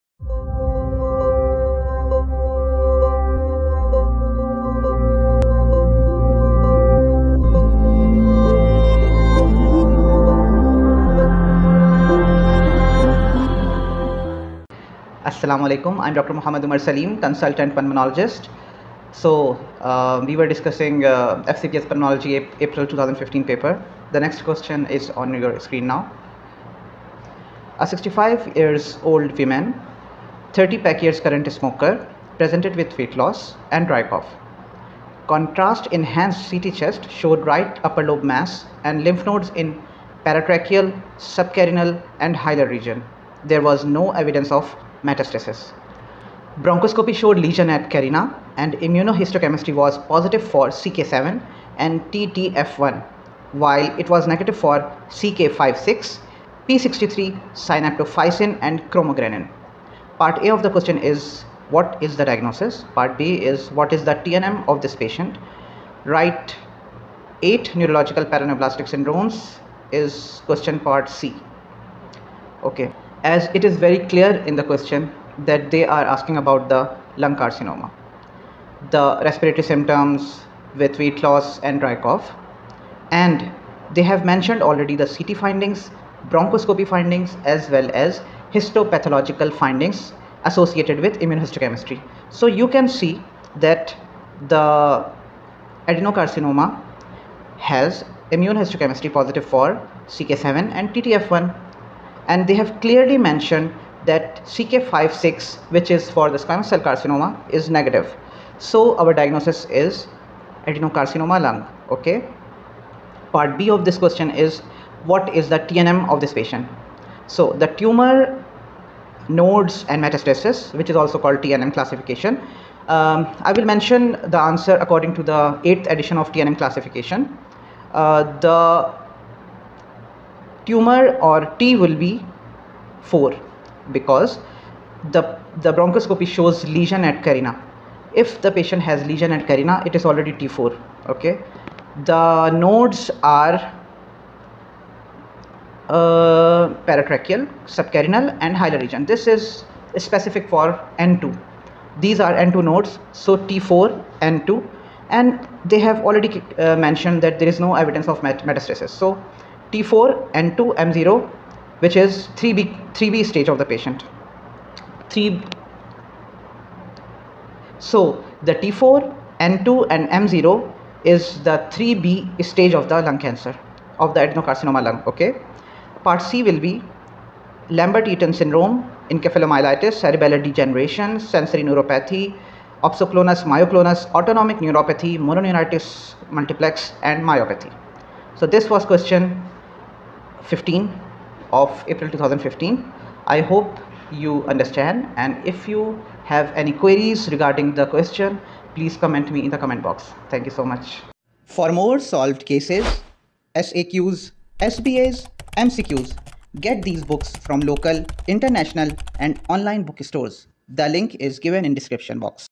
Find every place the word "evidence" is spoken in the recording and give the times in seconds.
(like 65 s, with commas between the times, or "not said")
44 s, 157 s.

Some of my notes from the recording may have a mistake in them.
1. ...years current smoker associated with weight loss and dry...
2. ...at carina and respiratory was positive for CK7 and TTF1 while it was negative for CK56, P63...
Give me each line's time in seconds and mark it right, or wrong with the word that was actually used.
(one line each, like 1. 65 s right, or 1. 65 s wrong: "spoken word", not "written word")
1. 31 s wrong: "presented", not "associated"
2. 47 s wrong: "immunohistochemistry", not "respiratory".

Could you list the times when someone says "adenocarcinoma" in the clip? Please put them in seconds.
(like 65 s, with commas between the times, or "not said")
95 s, 110 s, 174 s.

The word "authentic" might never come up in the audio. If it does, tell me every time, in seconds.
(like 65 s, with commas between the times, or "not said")
not said.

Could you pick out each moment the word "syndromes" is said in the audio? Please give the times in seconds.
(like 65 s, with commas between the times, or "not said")
68 s, 178 s.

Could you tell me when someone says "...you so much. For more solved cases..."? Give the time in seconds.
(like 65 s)
200 s.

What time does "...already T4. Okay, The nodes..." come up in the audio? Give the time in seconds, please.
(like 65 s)
140 s.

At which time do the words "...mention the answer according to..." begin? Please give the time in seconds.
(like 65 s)
123 s.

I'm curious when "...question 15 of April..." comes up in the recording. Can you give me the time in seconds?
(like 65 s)
188 s.